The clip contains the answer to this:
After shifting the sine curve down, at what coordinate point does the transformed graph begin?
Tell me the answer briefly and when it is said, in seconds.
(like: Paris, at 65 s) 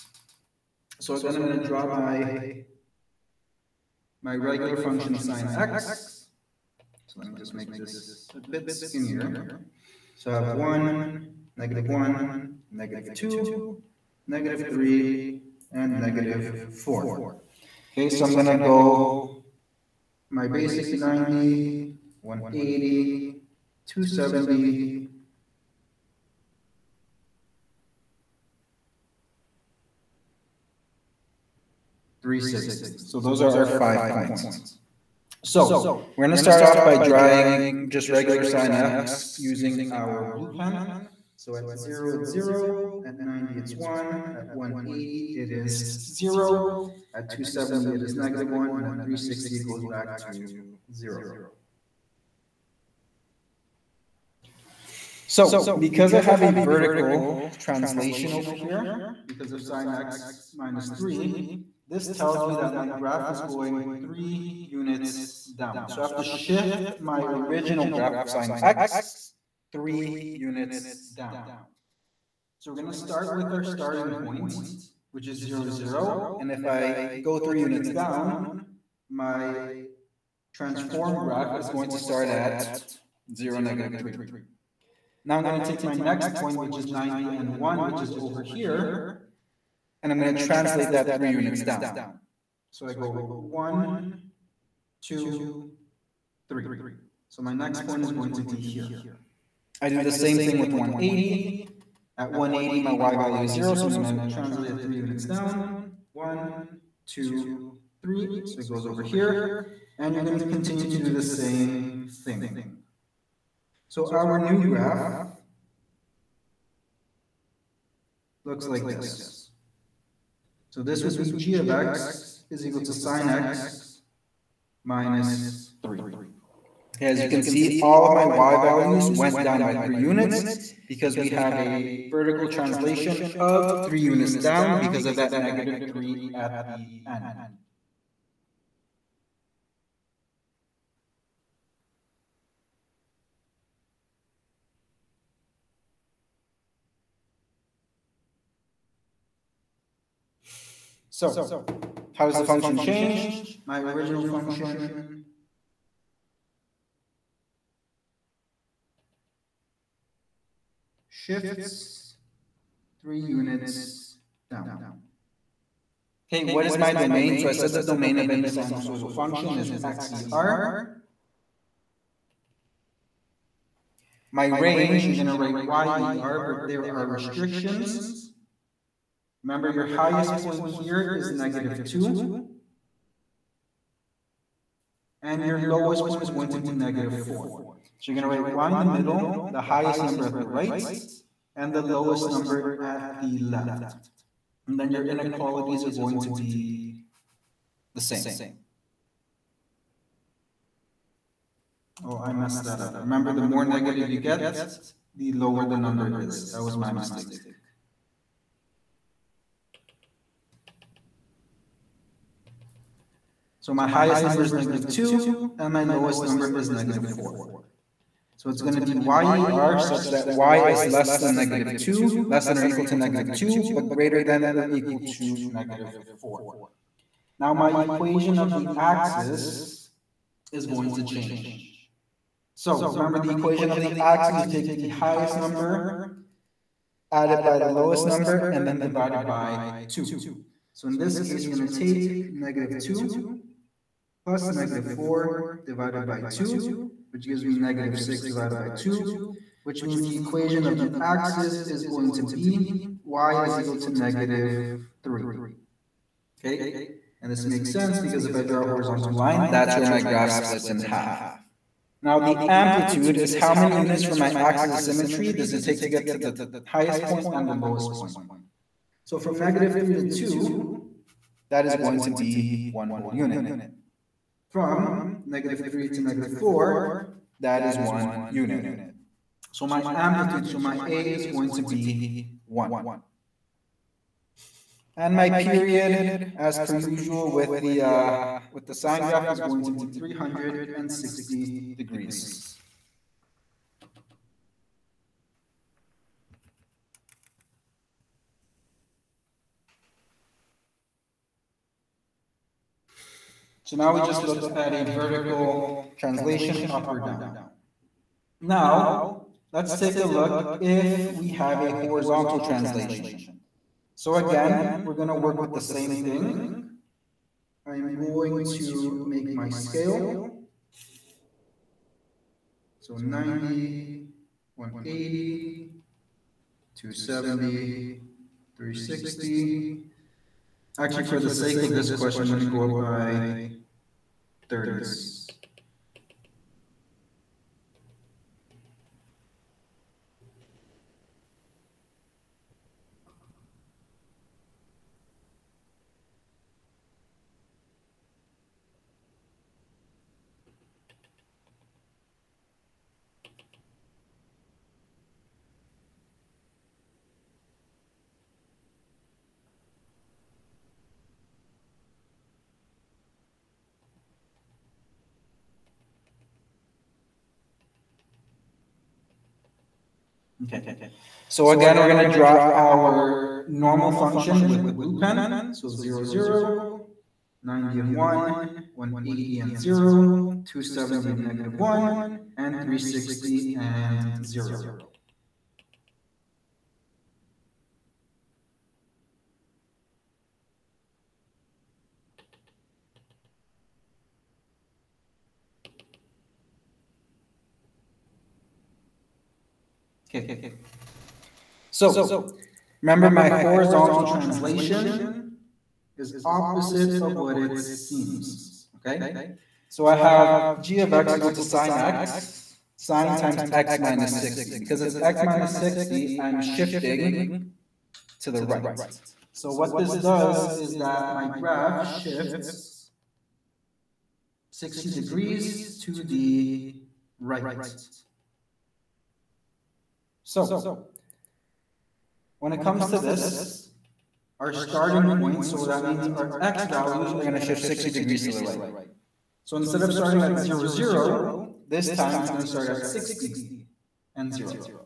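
(0, -3), at 83 s.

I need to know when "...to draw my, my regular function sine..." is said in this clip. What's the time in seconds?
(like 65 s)
1 s.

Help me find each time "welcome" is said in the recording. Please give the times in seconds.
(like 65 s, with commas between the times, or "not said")
not said.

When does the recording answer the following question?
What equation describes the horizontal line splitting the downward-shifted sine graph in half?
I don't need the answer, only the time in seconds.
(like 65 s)
253 s.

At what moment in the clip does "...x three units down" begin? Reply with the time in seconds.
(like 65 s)
68 s.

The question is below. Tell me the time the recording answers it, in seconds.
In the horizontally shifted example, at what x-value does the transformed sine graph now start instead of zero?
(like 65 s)
442 s.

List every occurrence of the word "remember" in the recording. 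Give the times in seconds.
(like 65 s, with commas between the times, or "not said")
179 s, 202 s, 232 s, 402 s.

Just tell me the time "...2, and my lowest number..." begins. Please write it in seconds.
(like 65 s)
214 s.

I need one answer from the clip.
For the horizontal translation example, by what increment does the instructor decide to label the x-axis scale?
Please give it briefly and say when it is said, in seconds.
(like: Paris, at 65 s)
30s, at 334 s.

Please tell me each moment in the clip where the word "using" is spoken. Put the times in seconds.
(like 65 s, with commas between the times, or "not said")
39 s.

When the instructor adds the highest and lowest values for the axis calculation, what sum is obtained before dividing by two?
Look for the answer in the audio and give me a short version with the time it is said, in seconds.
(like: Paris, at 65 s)
-6, at 247 s.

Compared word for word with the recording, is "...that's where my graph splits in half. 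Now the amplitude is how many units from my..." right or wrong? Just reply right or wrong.
right.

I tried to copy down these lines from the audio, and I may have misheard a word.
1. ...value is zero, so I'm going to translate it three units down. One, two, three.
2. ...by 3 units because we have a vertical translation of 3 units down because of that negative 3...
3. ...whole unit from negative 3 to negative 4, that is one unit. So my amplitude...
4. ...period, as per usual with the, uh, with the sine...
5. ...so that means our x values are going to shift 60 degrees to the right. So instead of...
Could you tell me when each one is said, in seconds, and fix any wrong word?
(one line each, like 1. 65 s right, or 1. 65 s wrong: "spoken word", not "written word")
1. 103 s right
2. 129 s right
3. 272 s right
4. 285 s right
5. 435 s right.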